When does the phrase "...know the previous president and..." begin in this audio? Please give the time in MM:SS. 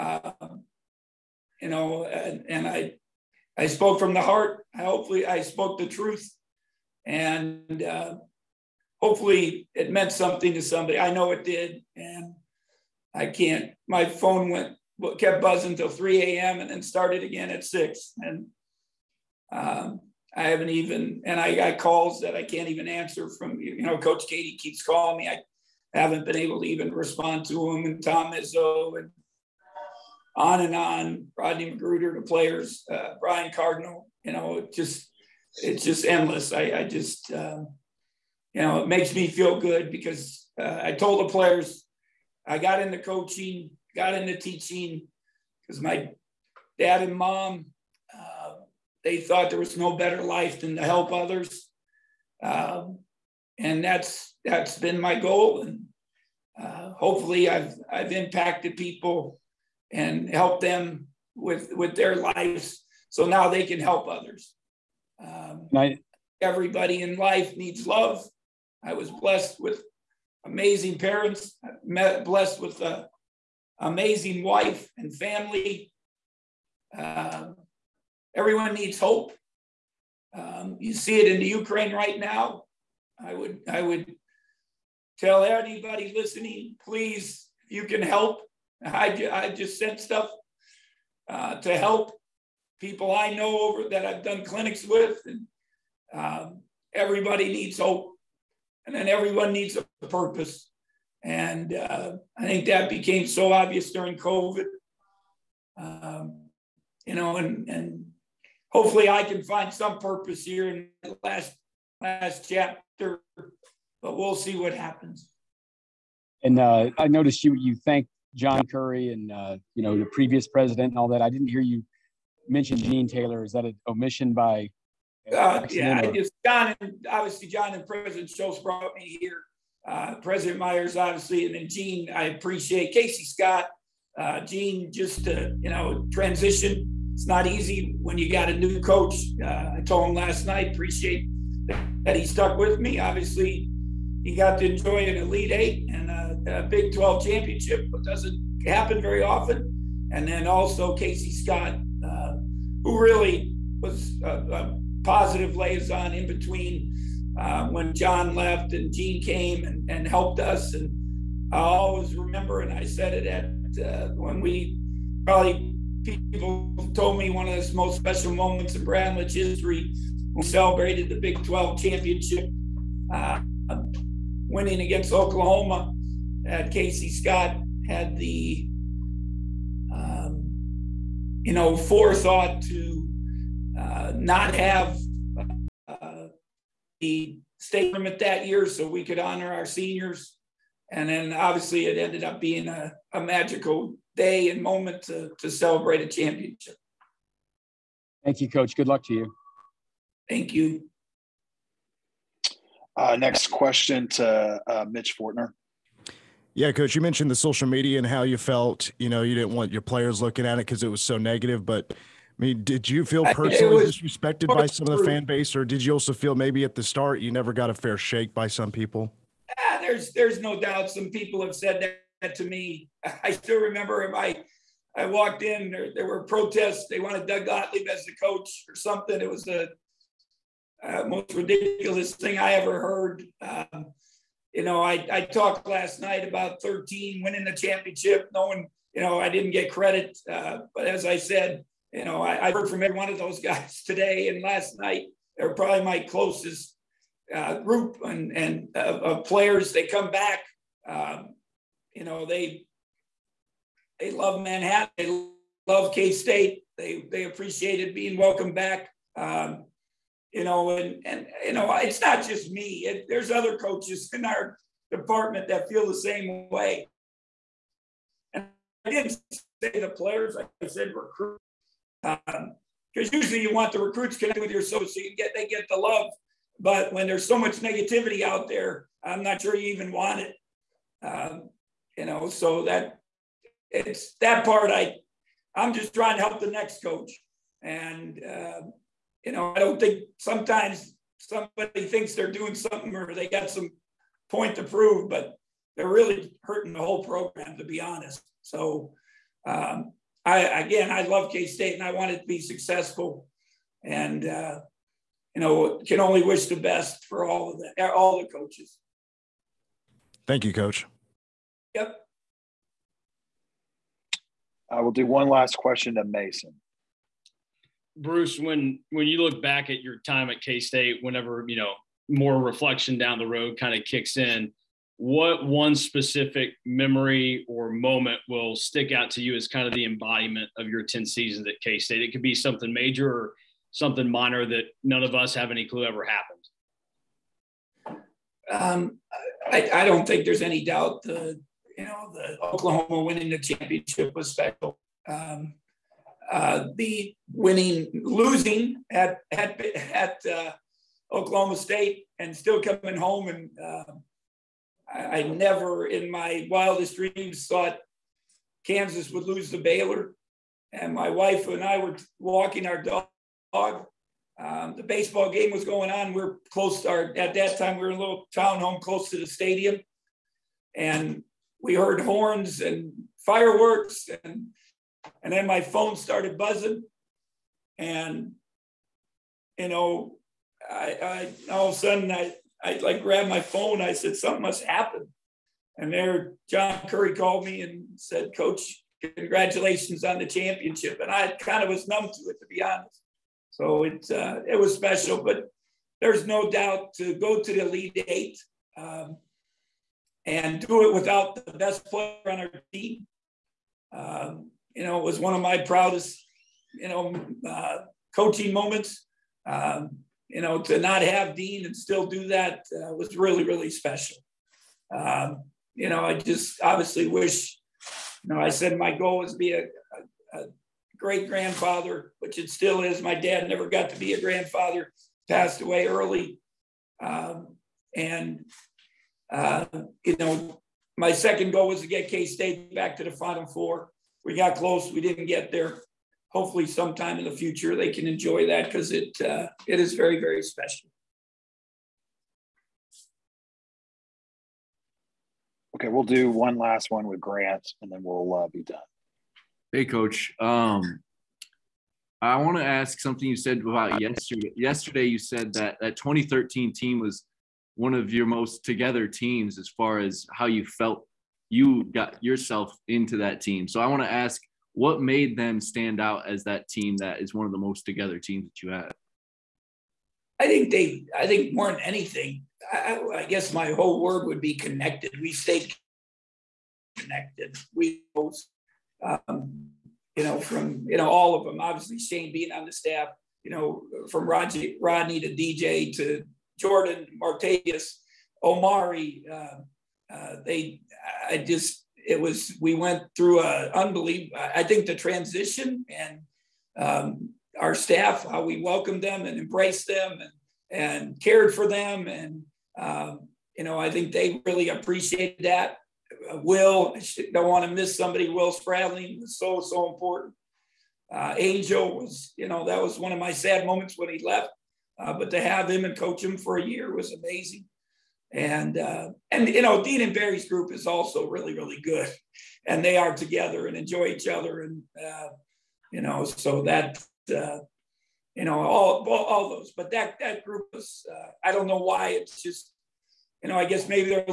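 01:59.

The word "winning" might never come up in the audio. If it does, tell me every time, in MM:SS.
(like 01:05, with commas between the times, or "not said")
02:54, 03:57, 05:43, 05:47.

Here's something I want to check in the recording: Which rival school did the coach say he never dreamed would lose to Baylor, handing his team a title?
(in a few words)
Kansas.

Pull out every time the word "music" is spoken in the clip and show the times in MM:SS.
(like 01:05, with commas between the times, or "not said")
not said.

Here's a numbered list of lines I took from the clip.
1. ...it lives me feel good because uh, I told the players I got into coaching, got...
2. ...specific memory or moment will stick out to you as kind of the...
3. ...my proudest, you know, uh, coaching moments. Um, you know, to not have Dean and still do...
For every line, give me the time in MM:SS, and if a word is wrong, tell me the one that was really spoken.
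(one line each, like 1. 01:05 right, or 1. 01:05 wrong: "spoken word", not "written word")
1. 00:38 wrong: "makes", not "lives"
2. 05:25 right
3. 06:45 right.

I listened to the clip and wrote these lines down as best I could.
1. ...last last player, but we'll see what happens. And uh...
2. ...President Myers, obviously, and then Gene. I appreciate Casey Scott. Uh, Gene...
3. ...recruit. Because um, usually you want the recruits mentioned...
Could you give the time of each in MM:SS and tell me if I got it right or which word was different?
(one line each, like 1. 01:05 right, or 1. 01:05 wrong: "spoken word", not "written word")
1. 01:51 wrong: "chapter", not "player"
2. 02:10 right
3. 04:30 wrong: "connected", not "mentioned".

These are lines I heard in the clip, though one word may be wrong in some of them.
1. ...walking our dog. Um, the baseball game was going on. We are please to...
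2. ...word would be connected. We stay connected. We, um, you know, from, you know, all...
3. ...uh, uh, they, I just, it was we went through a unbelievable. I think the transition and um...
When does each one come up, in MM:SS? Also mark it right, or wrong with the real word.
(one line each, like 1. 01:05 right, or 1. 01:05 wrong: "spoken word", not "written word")
1. 06:02 wrong: "close", not "please"
2. 07:54 right
3. 08:09 right.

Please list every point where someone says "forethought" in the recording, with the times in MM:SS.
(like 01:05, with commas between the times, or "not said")
03:01.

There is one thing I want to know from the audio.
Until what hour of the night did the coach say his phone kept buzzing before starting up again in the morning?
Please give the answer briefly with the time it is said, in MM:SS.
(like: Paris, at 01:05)
3 a.m., at 00:15.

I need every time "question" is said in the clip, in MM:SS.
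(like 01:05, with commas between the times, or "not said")
03:23, 05:15.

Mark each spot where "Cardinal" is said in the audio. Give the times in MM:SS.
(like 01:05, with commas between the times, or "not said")
00:33.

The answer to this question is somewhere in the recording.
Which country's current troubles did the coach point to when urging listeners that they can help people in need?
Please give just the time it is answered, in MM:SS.
01:21.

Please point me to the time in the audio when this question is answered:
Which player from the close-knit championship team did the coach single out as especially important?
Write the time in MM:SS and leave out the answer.
08:28.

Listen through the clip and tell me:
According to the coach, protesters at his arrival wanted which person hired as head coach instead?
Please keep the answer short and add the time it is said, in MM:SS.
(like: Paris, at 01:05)
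Doug Gottlieb, at 03:47.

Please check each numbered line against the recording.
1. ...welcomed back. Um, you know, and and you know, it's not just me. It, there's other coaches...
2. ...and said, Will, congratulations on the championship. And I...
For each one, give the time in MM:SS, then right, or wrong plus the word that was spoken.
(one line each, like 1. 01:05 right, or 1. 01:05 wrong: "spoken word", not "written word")
1. 04:18 right
2. 06:27 wrong: "Coach", not "Will".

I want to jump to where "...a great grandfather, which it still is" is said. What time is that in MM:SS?
07:00.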